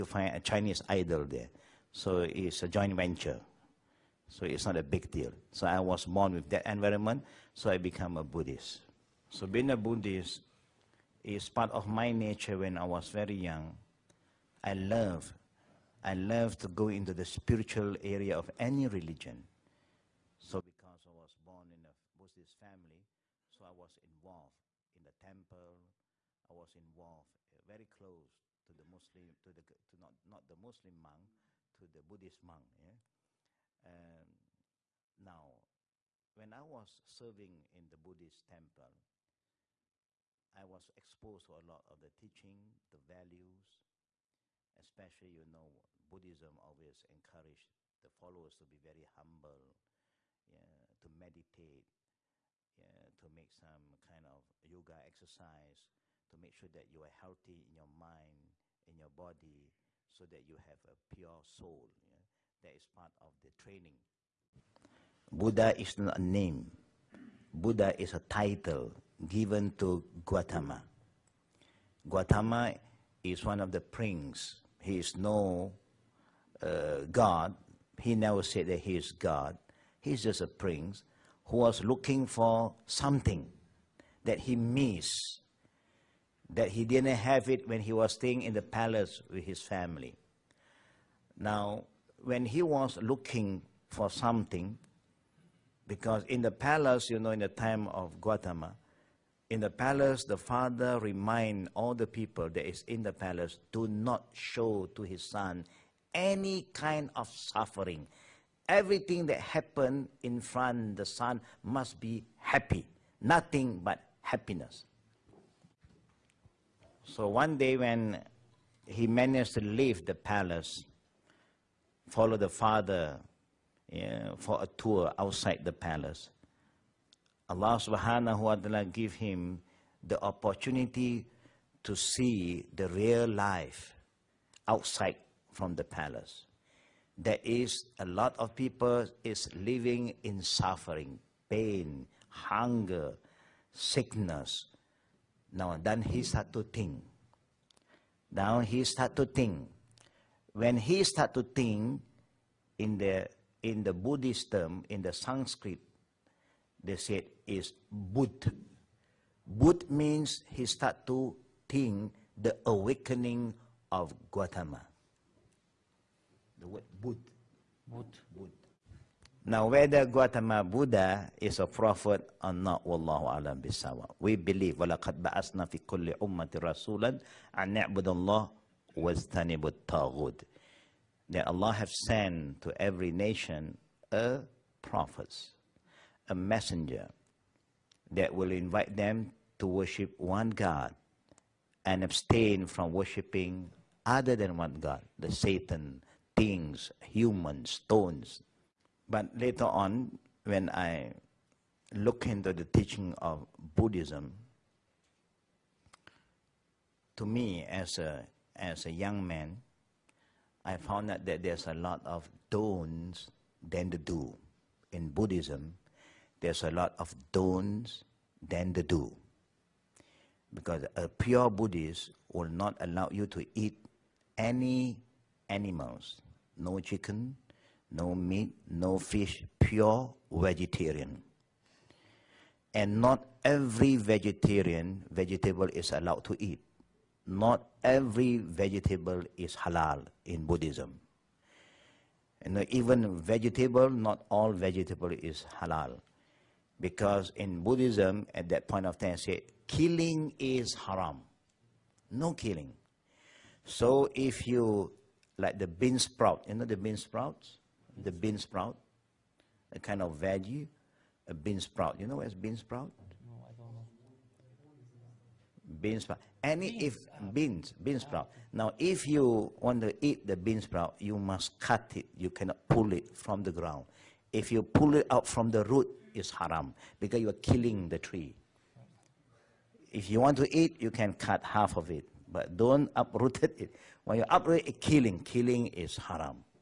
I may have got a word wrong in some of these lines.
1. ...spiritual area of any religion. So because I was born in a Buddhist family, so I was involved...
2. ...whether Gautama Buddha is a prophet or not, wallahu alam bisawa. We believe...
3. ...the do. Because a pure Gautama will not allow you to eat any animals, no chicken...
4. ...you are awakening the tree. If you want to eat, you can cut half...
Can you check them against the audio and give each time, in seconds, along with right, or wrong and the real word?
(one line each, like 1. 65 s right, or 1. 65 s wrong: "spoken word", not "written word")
1. 17 s right
2. 169 s right
3. 218 s wrong: "Buddhist", not "Gautama"
4. 277 s wrong: "killing", not "awakening".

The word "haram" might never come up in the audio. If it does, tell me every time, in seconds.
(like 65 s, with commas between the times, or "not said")
250 s, 276 s, 285 s.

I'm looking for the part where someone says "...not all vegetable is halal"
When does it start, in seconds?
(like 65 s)
243 s.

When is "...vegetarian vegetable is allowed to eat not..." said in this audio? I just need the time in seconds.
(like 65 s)
233 s.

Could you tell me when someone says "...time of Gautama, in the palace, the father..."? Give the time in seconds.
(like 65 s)
97 s.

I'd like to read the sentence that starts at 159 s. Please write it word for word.
Buddh means he start to think the awakening of Gautama.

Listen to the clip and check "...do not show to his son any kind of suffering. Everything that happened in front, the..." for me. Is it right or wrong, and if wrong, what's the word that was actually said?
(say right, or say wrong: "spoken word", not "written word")
right.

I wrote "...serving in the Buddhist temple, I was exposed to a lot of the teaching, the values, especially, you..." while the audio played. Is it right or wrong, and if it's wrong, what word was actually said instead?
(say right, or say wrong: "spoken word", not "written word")
right.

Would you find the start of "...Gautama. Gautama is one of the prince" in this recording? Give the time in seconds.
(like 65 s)
70 s.